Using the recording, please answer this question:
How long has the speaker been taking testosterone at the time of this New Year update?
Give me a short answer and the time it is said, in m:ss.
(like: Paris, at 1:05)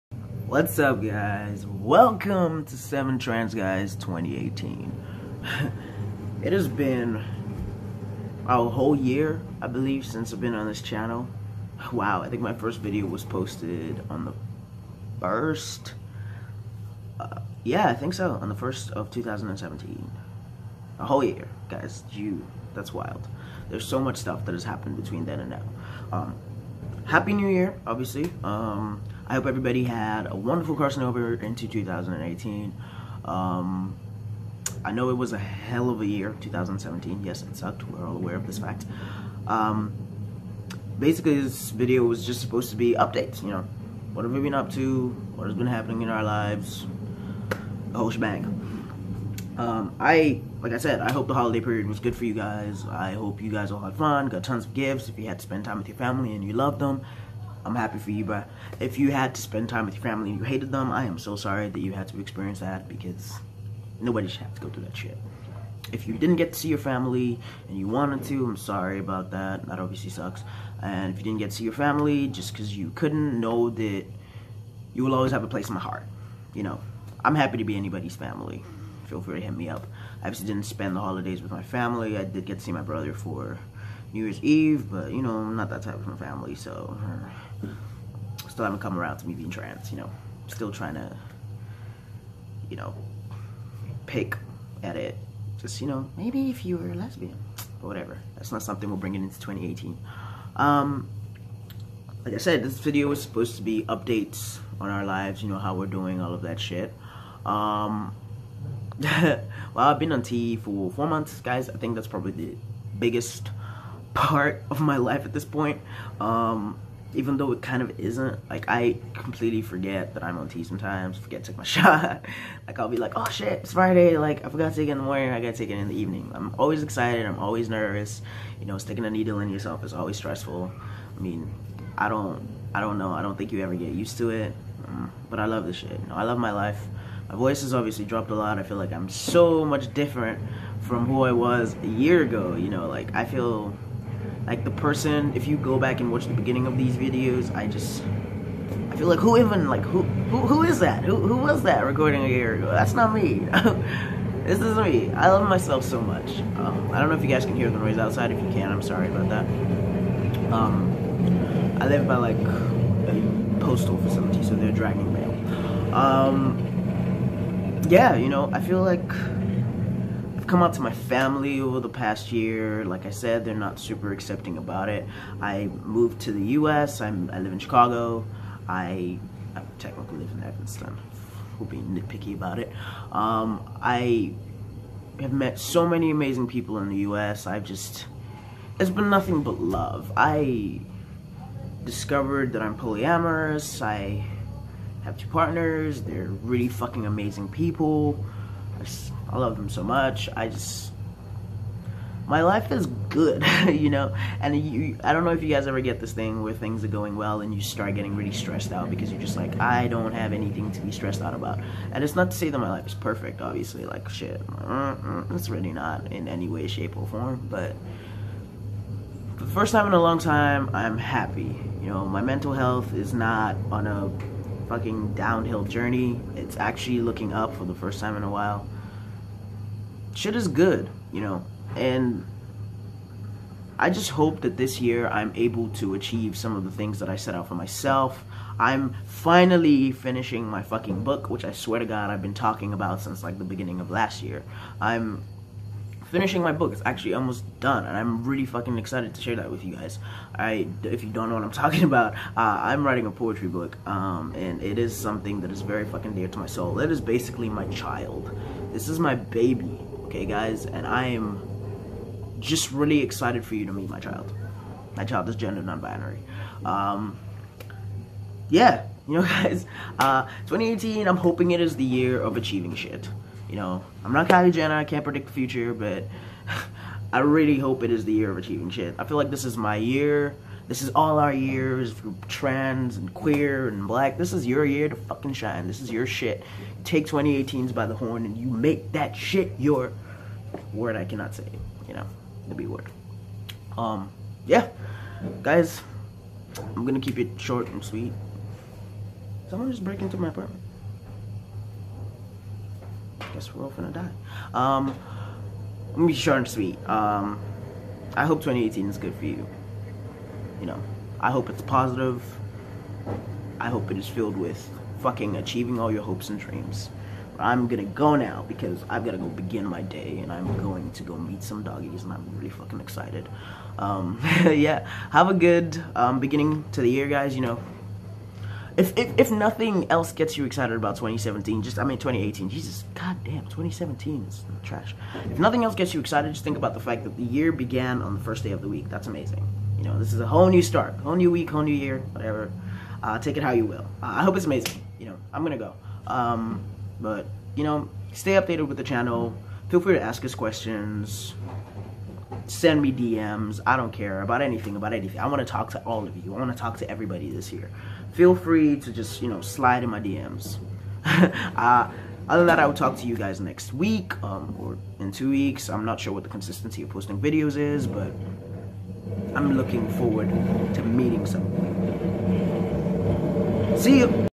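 4 months, at 1:50.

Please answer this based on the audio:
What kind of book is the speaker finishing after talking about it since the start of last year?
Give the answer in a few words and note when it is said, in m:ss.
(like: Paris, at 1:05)
Poetry book, at 4:13.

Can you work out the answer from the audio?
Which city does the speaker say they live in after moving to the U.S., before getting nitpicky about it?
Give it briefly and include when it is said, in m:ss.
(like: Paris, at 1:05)
Chicago, at 2:57.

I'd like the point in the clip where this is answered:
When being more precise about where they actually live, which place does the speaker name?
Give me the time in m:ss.
3:00.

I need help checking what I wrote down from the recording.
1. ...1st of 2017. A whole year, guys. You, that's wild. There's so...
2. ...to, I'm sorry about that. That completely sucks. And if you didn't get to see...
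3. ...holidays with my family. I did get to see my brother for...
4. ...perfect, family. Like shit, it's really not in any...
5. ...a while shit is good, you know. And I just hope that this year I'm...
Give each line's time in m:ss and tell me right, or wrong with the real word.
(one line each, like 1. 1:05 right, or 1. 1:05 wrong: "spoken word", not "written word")
1. 0:18 right
2. 1:08 wrong: "obviously", not "completely"
3. 1:21 right
4. 3:32 wrong: "obviously", not "family"
5. 3:48 right.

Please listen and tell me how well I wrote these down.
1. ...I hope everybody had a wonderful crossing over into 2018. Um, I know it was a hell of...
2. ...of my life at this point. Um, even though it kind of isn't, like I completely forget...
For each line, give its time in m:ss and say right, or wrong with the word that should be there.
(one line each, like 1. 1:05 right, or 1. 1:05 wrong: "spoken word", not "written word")
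1. 0:29 right
2. 1:54 right.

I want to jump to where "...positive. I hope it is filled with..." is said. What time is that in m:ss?
5:11.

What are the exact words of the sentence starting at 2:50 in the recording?
my family over the past year.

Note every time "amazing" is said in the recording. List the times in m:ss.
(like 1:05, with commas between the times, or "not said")
3:06, 3:17, 5:39, 5:44.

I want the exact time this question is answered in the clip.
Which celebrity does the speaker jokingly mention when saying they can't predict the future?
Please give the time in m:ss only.
4:34.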